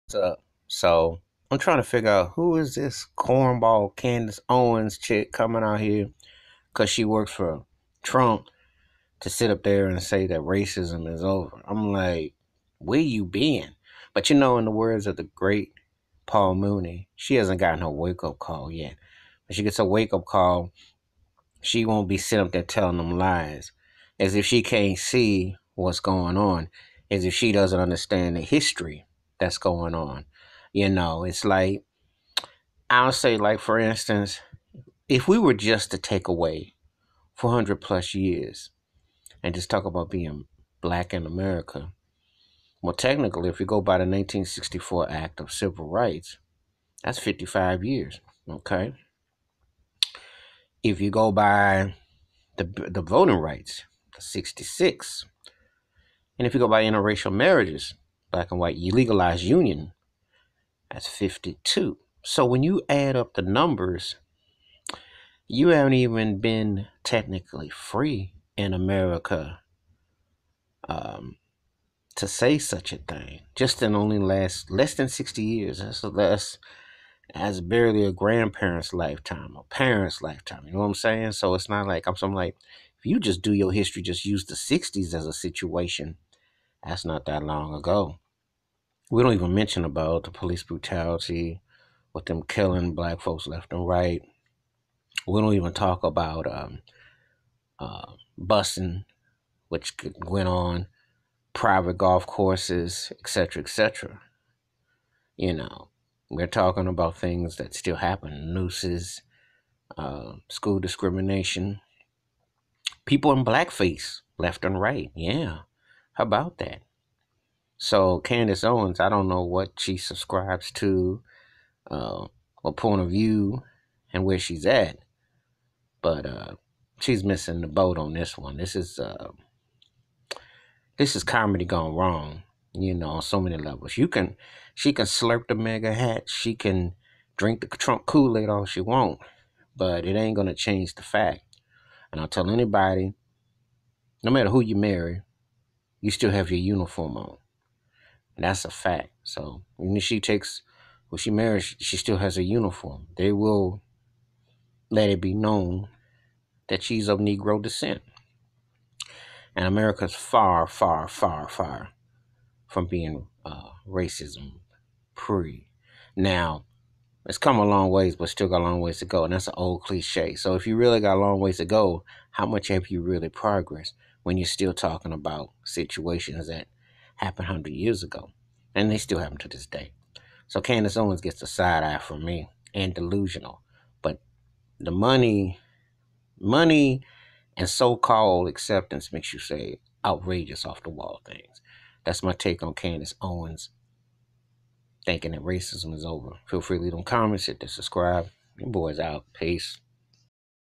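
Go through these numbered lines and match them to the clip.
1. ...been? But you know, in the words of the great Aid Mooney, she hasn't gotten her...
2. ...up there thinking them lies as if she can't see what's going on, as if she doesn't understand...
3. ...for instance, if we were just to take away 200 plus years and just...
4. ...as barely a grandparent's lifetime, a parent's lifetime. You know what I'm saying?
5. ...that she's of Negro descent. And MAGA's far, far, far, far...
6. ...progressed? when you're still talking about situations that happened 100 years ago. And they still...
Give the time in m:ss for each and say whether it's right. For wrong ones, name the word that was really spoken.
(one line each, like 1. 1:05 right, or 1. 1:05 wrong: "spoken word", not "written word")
1. 0:13 wrong: "Paul", not "Aid"
2. 0:22 wrong: "telling", not "thinking"
3. 0:33 wrong: "400", not "200"
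4. 1:17 right
5. 2:36 wrong: "America", not "MAGA"
6. 2:53 right.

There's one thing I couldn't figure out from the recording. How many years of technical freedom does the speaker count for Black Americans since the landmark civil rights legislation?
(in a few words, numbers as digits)
55.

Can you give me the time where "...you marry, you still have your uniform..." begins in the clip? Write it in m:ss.
2:24.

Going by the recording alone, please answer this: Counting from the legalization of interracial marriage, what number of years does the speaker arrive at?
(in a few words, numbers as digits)
52.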